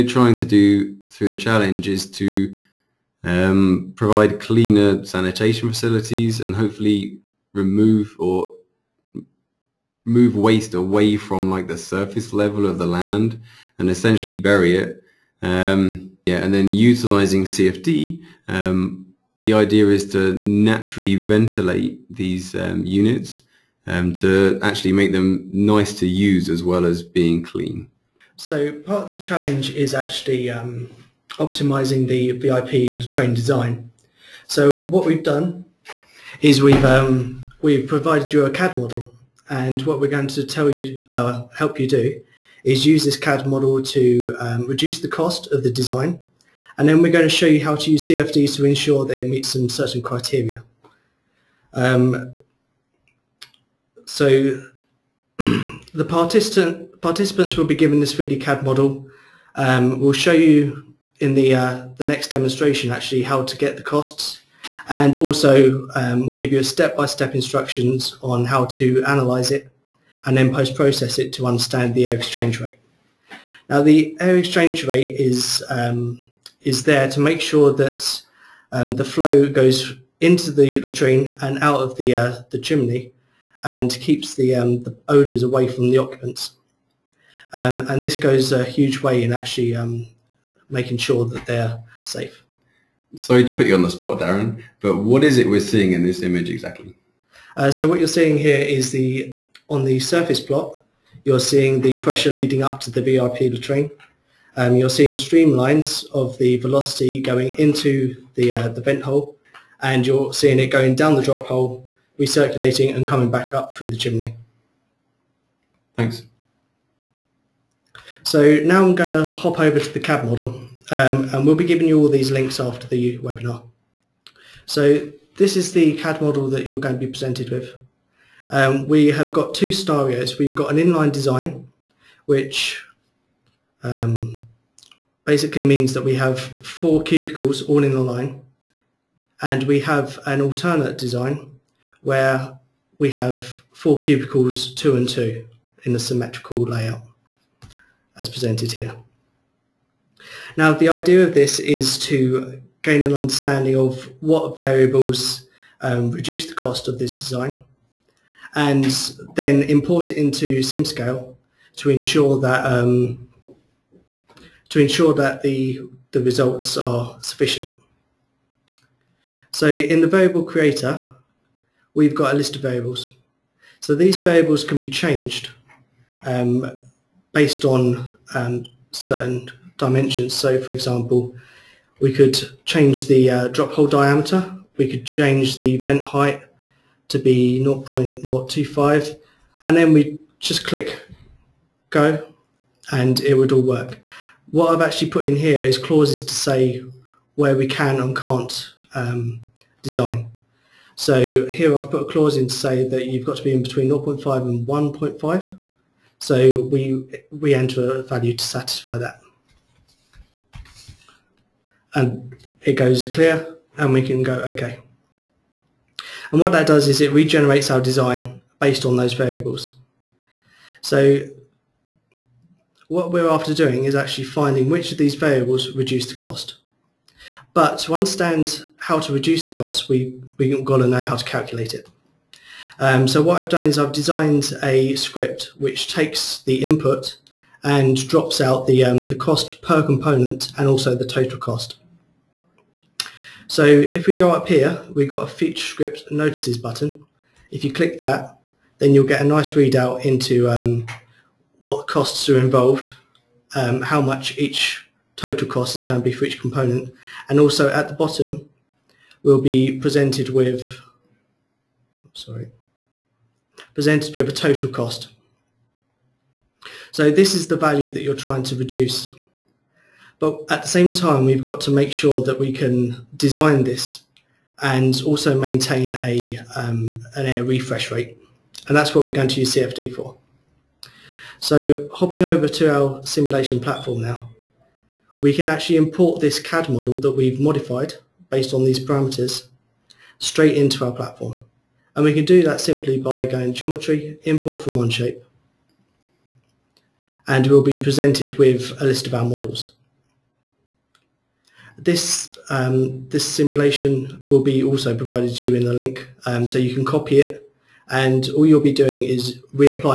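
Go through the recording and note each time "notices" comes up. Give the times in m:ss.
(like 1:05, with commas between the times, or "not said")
4:06.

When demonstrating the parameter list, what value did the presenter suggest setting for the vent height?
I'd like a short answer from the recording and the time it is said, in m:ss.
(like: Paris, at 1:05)
0.025, at 3:07.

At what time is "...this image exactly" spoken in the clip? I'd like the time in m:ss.
1:36.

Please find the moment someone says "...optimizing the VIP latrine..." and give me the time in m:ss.
0:31.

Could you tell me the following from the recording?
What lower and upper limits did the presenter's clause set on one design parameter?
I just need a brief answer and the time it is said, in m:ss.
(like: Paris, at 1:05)
0.5 and 1.5, at 3:23.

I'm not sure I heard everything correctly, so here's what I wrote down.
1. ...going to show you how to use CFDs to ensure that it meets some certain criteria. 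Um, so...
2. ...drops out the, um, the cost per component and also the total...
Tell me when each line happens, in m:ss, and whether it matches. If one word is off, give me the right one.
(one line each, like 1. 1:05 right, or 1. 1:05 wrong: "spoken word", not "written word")
1. 0:47 right
2. 3:58 right.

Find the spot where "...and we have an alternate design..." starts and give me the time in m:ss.
2:19.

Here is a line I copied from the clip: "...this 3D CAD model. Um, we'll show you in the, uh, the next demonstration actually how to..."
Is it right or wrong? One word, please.
right.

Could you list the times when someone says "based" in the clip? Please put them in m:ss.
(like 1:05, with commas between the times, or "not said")
2:57, 3:38, 4:48.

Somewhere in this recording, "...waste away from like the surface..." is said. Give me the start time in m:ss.
0:10.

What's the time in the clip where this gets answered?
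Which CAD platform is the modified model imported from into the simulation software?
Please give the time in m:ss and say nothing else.
4:54.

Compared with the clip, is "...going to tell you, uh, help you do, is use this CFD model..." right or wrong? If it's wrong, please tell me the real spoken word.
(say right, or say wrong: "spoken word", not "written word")
wrong: "CAD", not "CFD".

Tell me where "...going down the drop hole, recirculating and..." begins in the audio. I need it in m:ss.
1:50.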